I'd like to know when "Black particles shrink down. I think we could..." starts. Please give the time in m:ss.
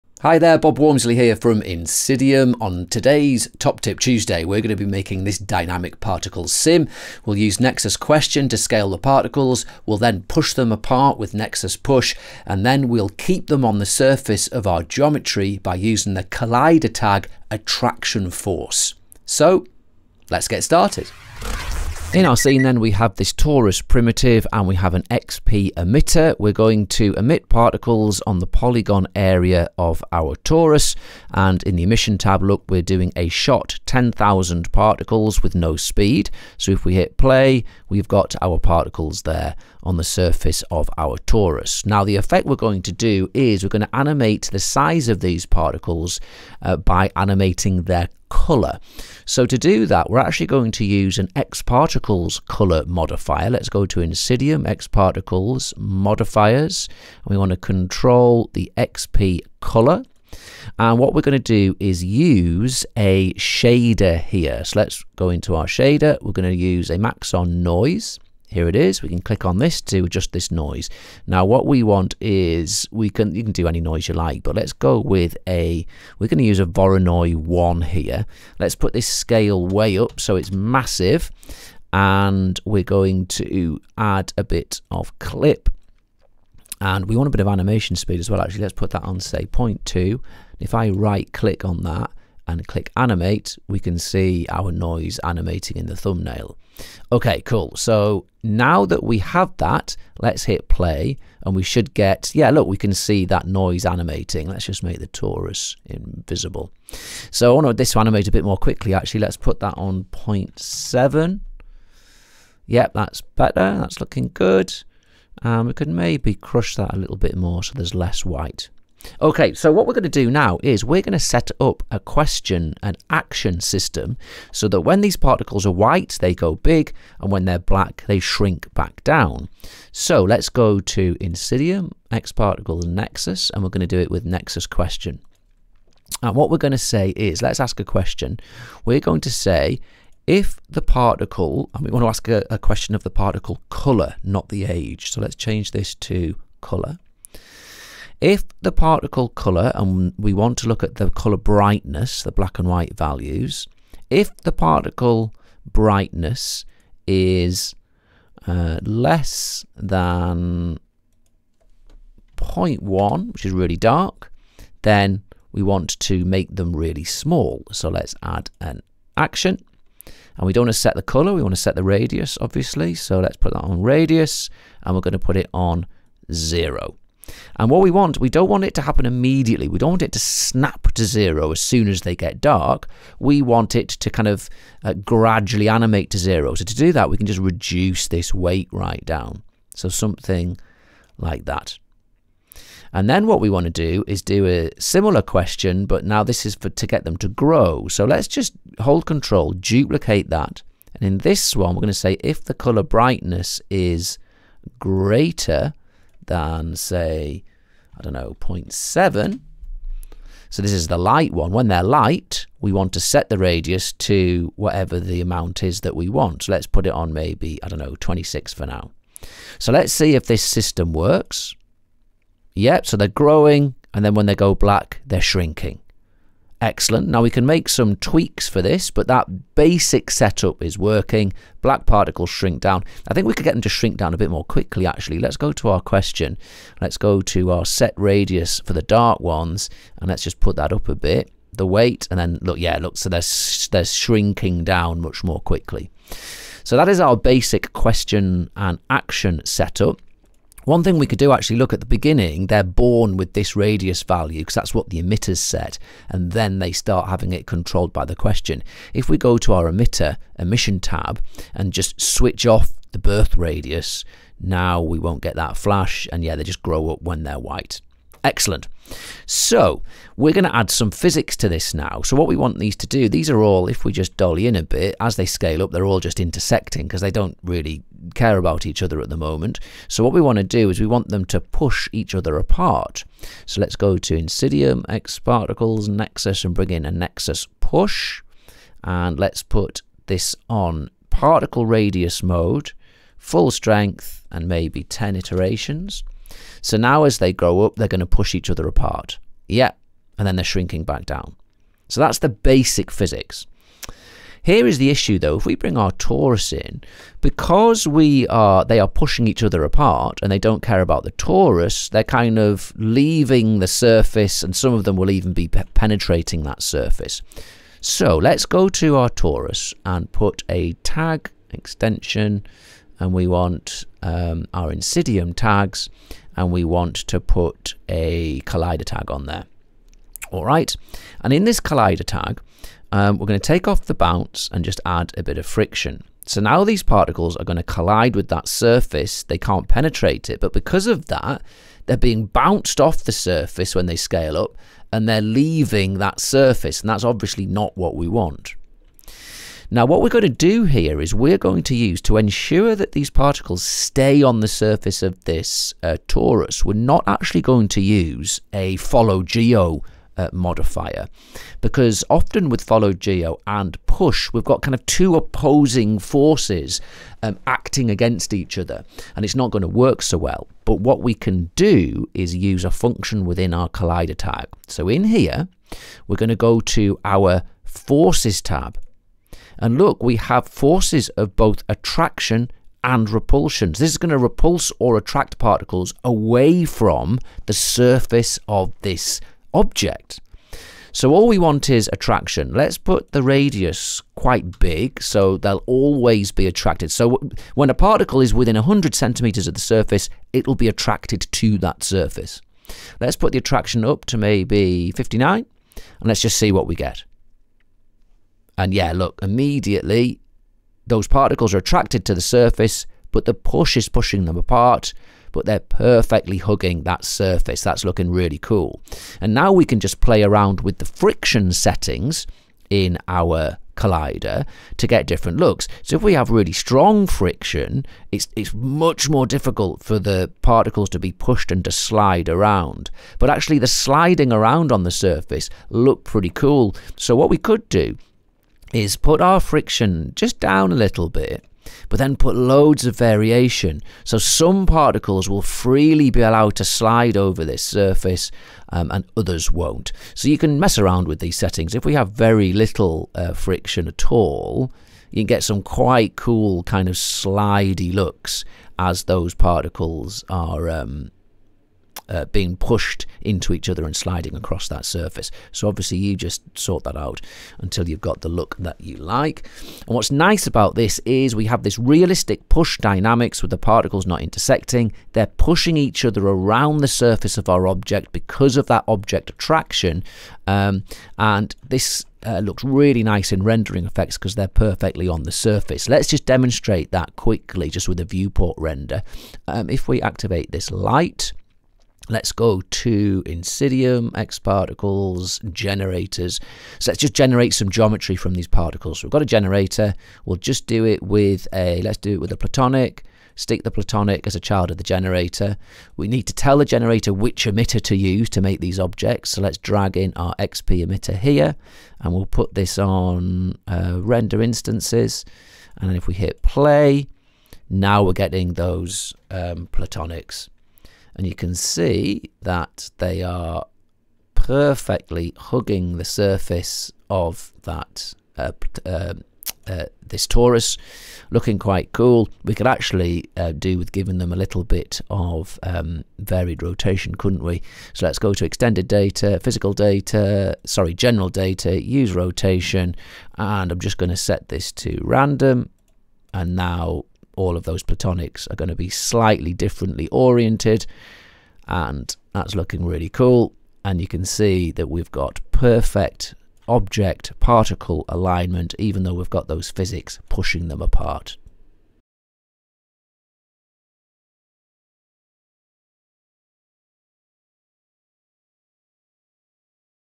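3:51.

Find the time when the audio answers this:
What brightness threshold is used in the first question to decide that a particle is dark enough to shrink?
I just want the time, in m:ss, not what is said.
2:42.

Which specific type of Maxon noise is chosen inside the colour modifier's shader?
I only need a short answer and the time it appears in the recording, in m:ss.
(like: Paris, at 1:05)
Voronoi 1, at 1:16.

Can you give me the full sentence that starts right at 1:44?
Let's just make the torus invisible.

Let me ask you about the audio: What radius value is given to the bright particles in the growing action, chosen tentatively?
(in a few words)
26.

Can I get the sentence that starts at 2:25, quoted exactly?
So let's change this to color.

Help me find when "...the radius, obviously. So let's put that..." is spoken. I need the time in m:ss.
2:51.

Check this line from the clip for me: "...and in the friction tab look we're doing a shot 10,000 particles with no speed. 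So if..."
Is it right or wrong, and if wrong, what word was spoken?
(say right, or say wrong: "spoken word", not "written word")
wrong: "emission", not "friction".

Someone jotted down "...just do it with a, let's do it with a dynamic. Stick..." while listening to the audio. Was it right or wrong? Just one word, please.
wrong.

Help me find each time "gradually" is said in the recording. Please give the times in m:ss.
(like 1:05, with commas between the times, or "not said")
3:04.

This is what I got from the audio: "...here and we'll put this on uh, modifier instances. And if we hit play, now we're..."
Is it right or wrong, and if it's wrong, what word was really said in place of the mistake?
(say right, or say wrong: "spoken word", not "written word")
wrong: "render", not "modifier".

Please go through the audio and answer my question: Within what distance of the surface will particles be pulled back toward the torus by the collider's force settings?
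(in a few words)
100 centimeters.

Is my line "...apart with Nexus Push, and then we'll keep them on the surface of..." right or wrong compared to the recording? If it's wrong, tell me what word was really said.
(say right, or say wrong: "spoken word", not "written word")
right.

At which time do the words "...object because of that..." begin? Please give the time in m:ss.
7:57.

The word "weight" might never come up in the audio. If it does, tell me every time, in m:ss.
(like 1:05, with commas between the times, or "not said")
3:08, 4:01.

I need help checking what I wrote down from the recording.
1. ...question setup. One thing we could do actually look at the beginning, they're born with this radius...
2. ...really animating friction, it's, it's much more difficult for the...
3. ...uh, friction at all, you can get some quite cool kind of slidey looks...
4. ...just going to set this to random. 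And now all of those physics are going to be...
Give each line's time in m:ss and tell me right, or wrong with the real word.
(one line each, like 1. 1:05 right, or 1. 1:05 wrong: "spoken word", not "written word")
1. 4:08 wrong: "action", not "question"
2. 7:06 wrong: "strong", not "animating"
3. 7:33 right
4. 9:03 wrong: "platonics", not "physics".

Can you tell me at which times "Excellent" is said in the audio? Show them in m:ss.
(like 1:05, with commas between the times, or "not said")
3:46, 4:28.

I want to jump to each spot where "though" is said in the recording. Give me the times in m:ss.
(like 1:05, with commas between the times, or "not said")
5:05, 9:19.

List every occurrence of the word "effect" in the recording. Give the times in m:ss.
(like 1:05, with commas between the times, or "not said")
0:42, 8:03.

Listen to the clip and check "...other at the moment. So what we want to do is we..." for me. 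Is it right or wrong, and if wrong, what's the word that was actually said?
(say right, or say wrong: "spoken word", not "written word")
right.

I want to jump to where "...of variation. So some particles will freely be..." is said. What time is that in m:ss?
7:22.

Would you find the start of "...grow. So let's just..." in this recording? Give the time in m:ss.
3:17.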